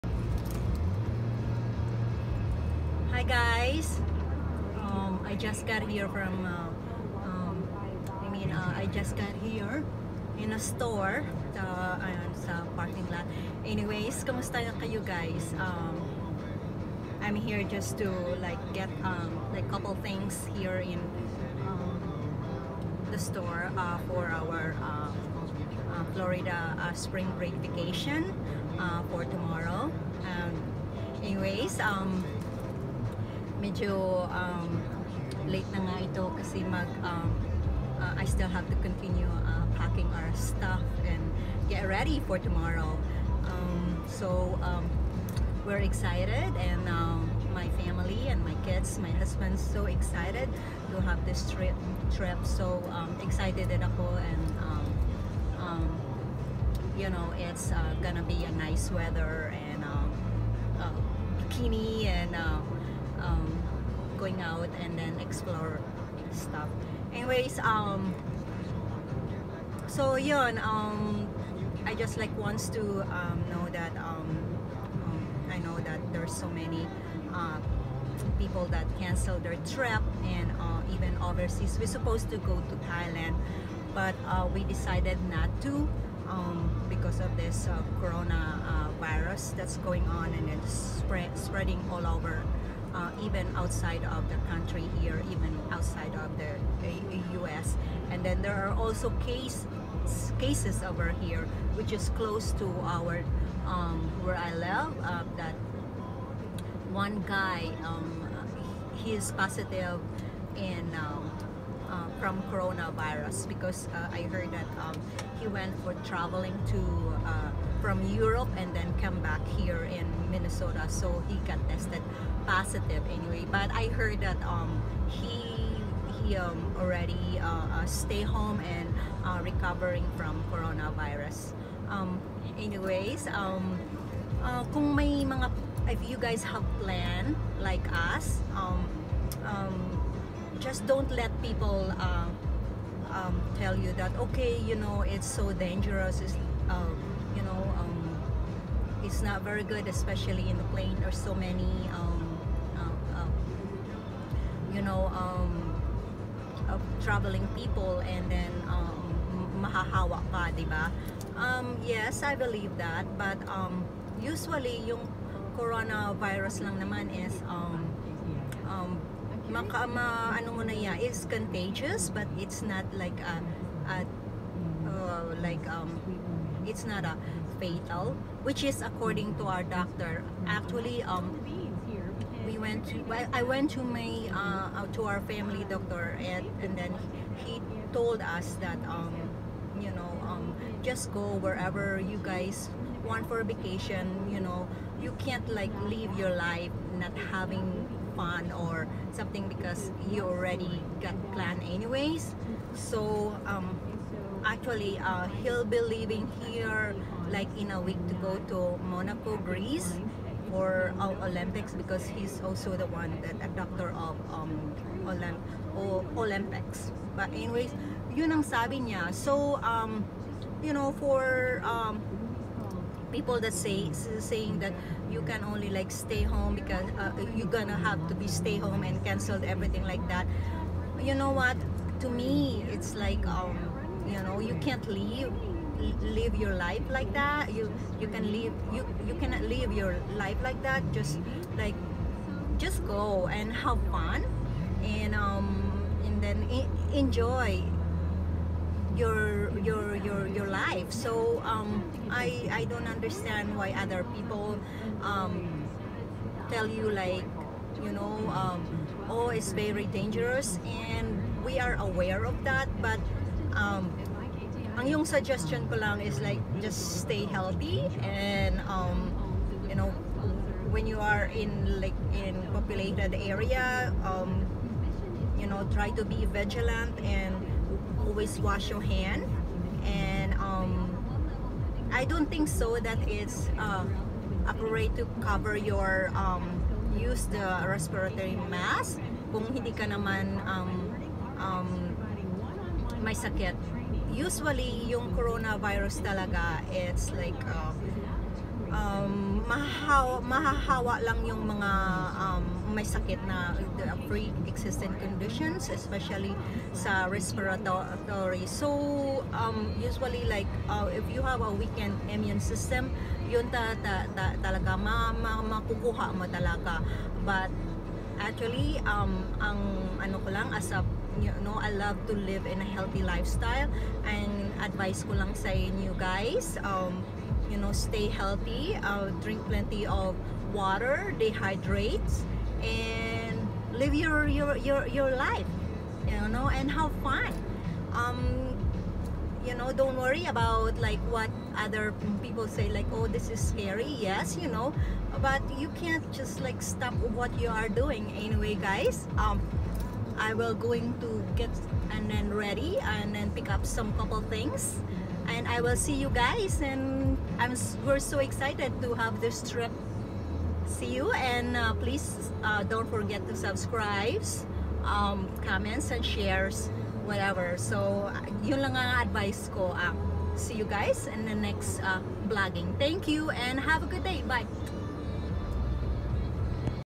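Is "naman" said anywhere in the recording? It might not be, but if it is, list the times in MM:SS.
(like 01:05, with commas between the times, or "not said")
02:46, 04:49.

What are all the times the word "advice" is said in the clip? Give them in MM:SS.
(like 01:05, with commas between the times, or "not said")
05:24, 06:09.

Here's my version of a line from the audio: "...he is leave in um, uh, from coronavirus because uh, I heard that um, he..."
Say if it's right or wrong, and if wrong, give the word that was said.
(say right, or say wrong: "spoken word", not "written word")
wrong: "positive", not "leave".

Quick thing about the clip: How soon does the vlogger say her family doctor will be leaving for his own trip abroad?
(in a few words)
in a week.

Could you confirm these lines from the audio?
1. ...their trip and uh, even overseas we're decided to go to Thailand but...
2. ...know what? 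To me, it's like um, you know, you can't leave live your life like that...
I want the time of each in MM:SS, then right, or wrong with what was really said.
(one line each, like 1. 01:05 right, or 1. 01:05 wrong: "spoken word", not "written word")
1. 01:19 wrong: "supposed", not "decided"
2. 03:51 right.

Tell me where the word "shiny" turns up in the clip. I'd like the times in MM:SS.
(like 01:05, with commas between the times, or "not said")
not said.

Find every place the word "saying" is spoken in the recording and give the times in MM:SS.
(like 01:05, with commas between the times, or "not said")
03:44.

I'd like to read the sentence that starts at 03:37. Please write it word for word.
But anyways, yun ang sabi niya.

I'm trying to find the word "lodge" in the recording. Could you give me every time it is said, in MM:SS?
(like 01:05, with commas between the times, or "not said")
not said.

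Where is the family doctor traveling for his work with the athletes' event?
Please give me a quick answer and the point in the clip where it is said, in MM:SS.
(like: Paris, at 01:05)
Monaco Greece, at 03:28.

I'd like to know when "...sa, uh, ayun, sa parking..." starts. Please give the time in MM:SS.
00:11.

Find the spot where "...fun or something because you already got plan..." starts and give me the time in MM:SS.
03:18.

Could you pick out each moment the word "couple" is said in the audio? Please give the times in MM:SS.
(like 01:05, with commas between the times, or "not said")
00:19, 05:53.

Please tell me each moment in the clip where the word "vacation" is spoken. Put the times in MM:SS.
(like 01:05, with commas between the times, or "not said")
00:27, 03:13.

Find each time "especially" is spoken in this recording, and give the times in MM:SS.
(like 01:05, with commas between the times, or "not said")
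02:29, 05:05.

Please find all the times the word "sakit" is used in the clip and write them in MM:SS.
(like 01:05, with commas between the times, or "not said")
04:53, 05:02.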